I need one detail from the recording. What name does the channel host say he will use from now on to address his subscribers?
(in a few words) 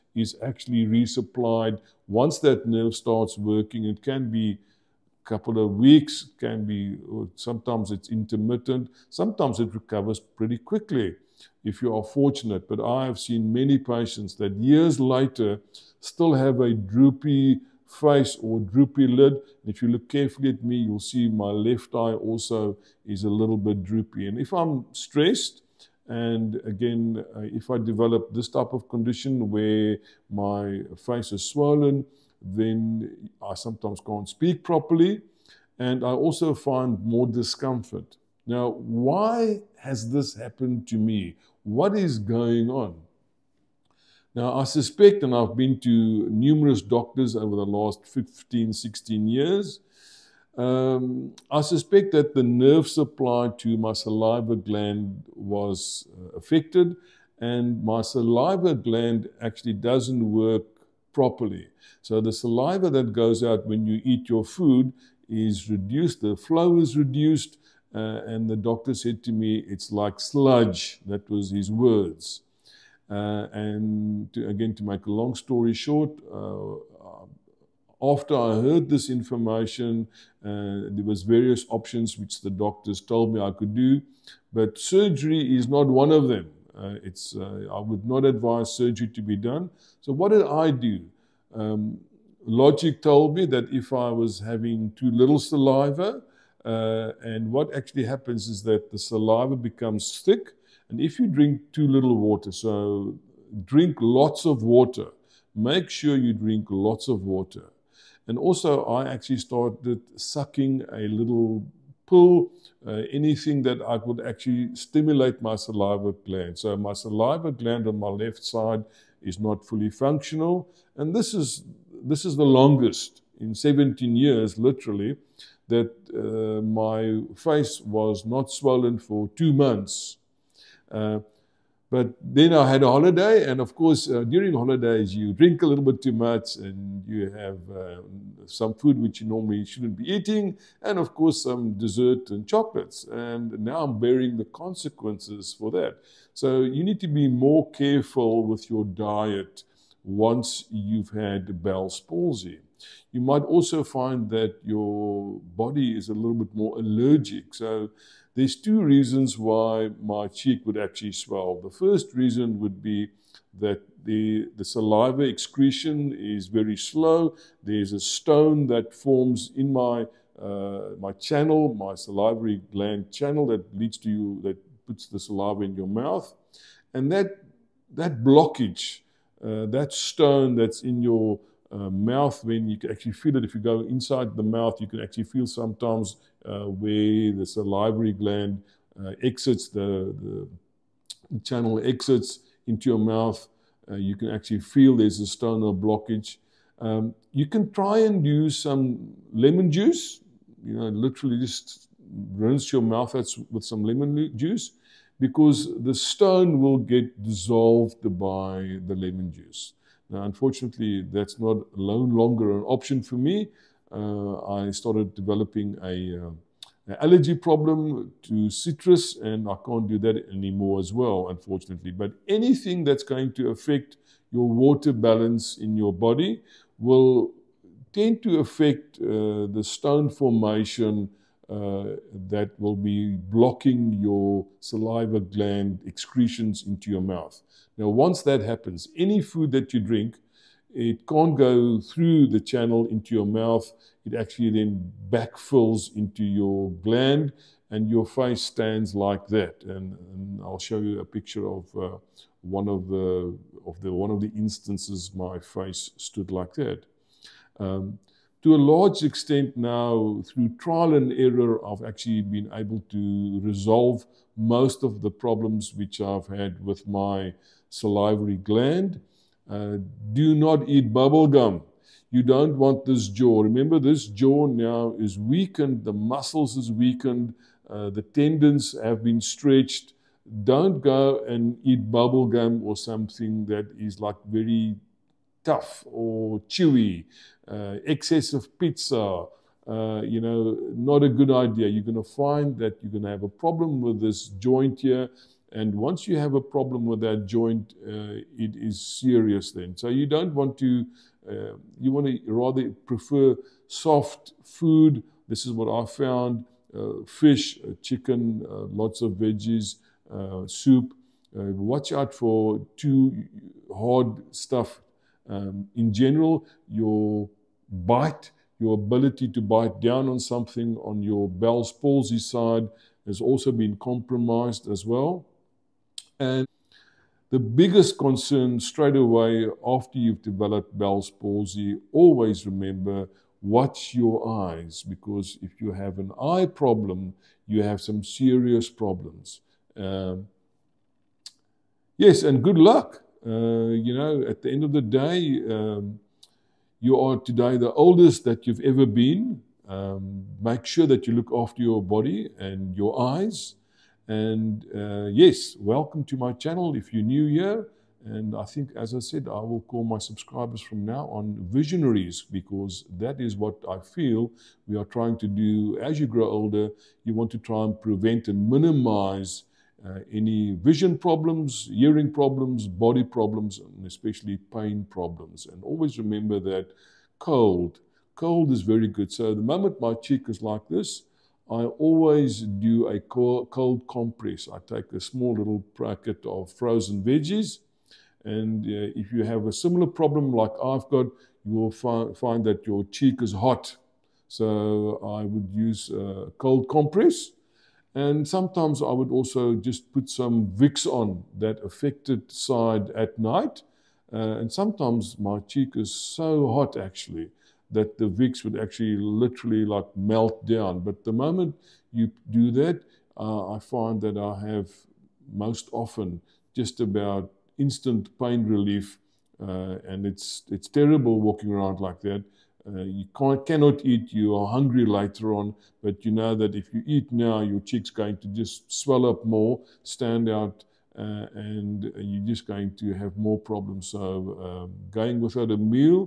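visionaries.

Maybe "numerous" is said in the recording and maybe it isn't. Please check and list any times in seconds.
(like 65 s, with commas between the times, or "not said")
46 s.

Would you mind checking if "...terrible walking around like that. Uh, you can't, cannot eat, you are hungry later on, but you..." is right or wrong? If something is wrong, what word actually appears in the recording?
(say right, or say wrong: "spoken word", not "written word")
right.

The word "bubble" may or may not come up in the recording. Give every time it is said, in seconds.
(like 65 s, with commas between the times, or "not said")
270 s, 281 s.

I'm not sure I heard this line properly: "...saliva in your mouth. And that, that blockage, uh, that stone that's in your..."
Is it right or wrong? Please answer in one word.
right.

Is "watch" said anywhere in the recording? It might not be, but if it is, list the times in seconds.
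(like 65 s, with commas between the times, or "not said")
311 s, 333 s.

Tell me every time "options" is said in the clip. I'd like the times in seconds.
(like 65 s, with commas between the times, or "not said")
81 s, 212 s.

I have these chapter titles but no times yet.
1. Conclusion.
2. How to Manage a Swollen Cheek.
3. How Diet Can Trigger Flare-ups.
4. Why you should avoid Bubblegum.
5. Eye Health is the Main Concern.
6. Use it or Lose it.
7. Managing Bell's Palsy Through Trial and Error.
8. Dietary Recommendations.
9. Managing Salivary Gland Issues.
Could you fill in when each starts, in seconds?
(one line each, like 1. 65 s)
1. 327 s
2. 182 s
3. 10 s
4. 132 s
5. 301 s
6. 43 s
7. 222 s
8. 258 s
9. 91 s.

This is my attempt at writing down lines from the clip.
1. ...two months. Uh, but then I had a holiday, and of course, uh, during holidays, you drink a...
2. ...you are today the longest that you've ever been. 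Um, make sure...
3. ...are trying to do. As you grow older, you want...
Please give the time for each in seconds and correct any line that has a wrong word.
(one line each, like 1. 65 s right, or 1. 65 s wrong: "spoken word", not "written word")
1. 129 s right
2. 346 s wrong: "oldest", not "longest"
3. 364 s right.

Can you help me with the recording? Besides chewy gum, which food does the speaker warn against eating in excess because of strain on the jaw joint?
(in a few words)
pizza.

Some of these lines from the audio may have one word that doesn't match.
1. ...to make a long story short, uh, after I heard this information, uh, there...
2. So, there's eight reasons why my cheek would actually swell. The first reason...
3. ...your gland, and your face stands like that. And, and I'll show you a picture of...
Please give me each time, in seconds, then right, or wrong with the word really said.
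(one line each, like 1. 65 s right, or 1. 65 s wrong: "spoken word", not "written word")
1. 74 s right
2. 157 s wrong: "two", not "eight"
3. 246 s right.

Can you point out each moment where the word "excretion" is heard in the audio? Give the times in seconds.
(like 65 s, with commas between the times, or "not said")
165 s, 235 s.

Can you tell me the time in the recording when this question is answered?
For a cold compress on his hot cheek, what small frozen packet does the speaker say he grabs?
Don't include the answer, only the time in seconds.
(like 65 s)
386 s.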